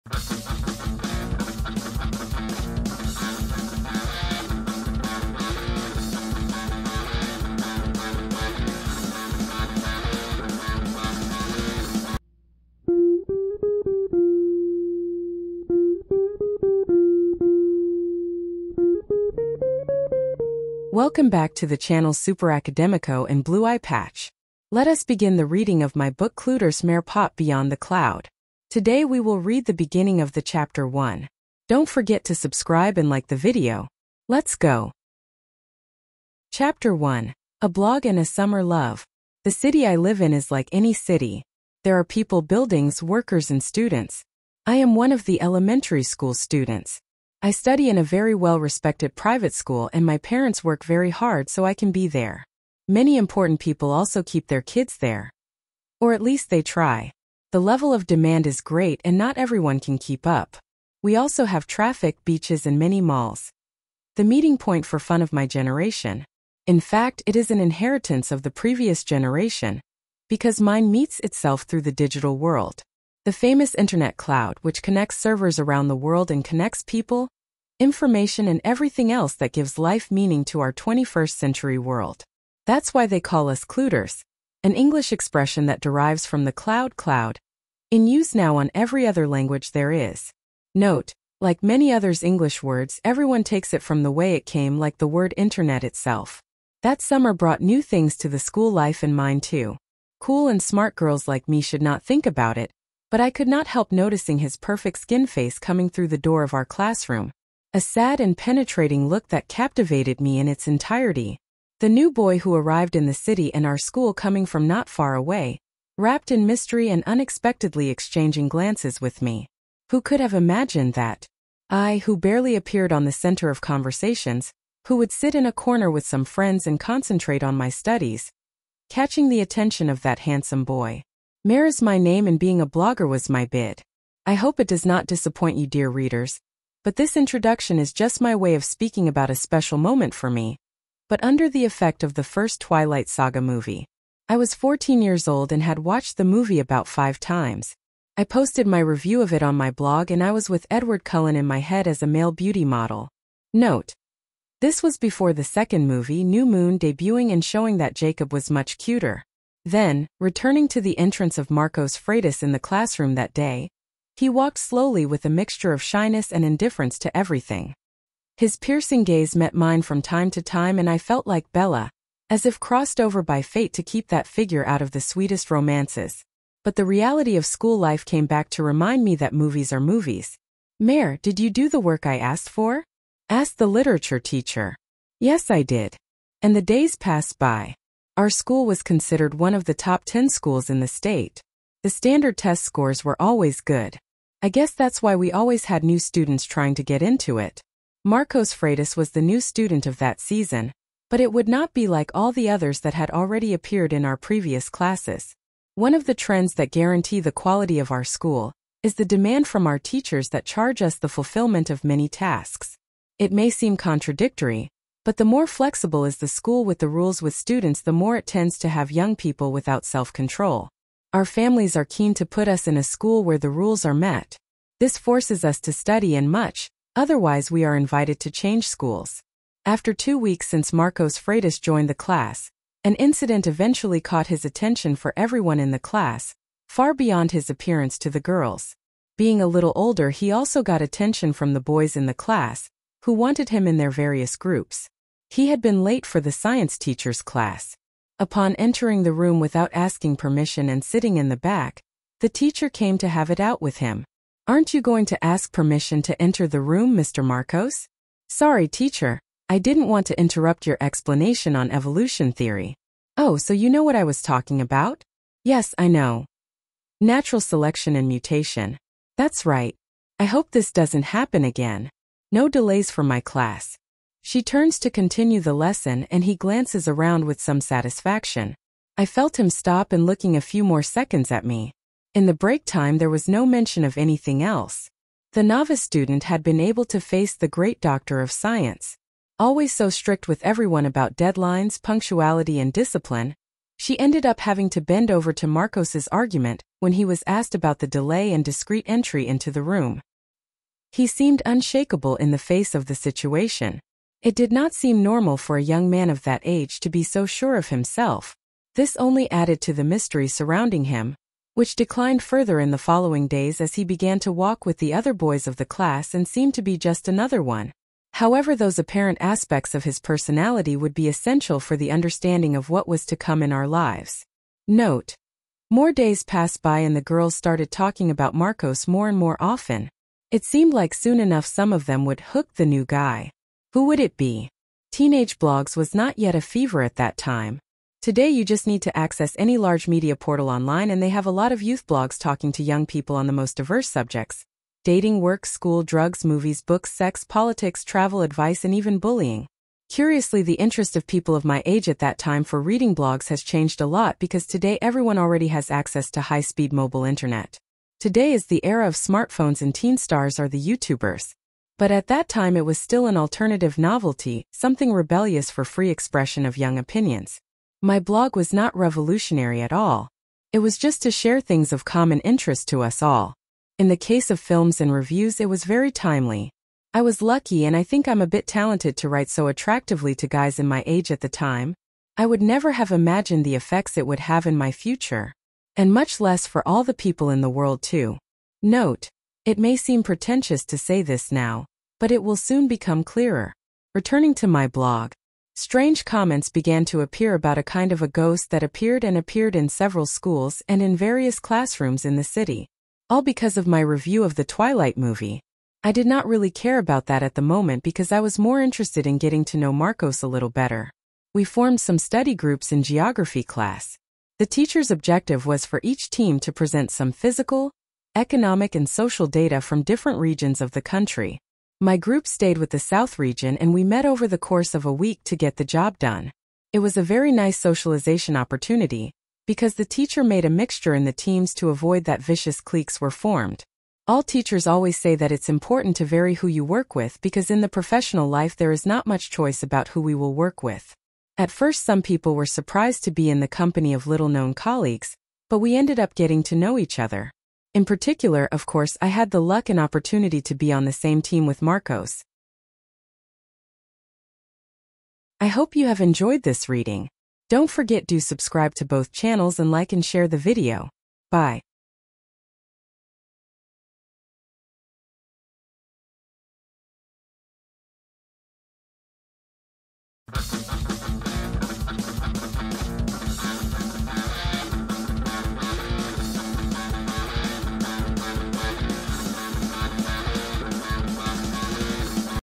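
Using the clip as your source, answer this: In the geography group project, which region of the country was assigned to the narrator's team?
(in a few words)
South region.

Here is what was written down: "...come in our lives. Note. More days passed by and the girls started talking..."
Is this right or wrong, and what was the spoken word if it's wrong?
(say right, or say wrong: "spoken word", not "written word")
right.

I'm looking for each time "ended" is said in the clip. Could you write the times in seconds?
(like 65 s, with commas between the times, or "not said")
293 s, 445 s.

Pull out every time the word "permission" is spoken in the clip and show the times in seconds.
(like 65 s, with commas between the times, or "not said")
250 s, 255 s.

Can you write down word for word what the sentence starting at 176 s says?
But the reality of school life came back to remind me that movies are movies.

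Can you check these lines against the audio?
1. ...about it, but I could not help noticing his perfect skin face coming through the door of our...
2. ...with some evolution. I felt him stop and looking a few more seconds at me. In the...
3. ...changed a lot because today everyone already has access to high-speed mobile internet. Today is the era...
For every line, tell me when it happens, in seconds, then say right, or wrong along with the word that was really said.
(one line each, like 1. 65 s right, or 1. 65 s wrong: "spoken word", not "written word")
1. 102 s right
2. 277 s wrong: "satisfaction", not "evolution"
3. 353 s right.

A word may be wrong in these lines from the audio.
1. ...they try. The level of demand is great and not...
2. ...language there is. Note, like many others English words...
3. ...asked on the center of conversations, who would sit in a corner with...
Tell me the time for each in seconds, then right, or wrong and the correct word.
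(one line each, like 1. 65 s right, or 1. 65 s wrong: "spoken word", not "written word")
1. 56 s right
2. 89 s right
3. 122 s wrong: "appeared", not "asked".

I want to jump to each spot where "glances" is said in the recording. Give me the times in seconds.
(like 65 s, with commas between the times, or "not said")
118 s, 276 s.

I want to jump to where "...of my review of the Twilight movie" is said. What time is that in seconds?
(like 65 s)
403 s.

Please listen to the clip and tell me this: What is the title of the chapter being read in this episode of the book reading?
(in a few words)
A Blog and a Summer Love.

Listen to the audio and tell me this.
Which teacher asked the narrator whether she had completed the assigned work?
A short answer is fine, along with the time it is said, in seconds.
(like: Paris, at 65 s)
literature teacher, at 183 s.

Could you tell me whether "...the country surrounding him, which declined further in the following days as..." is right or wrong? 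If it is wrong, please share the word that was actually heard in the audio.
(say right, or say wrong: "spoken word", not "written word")
wrong: "mystery", not "country".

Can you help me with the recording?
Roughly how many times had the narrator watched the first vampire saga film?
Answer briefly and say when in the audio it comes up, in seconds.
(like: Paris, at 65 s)
5, at 146 s.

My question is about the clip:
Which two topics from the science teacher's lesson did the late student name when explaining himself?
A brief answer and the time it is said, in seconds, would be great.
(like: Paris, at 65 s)
Natural selection and mutation, at 266 s.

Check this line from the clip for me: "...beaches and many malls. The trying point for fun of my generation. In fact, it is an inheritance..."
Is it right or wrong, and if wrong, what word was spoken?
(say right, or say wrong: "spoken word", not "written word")
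wrong: "meeting", not "trying".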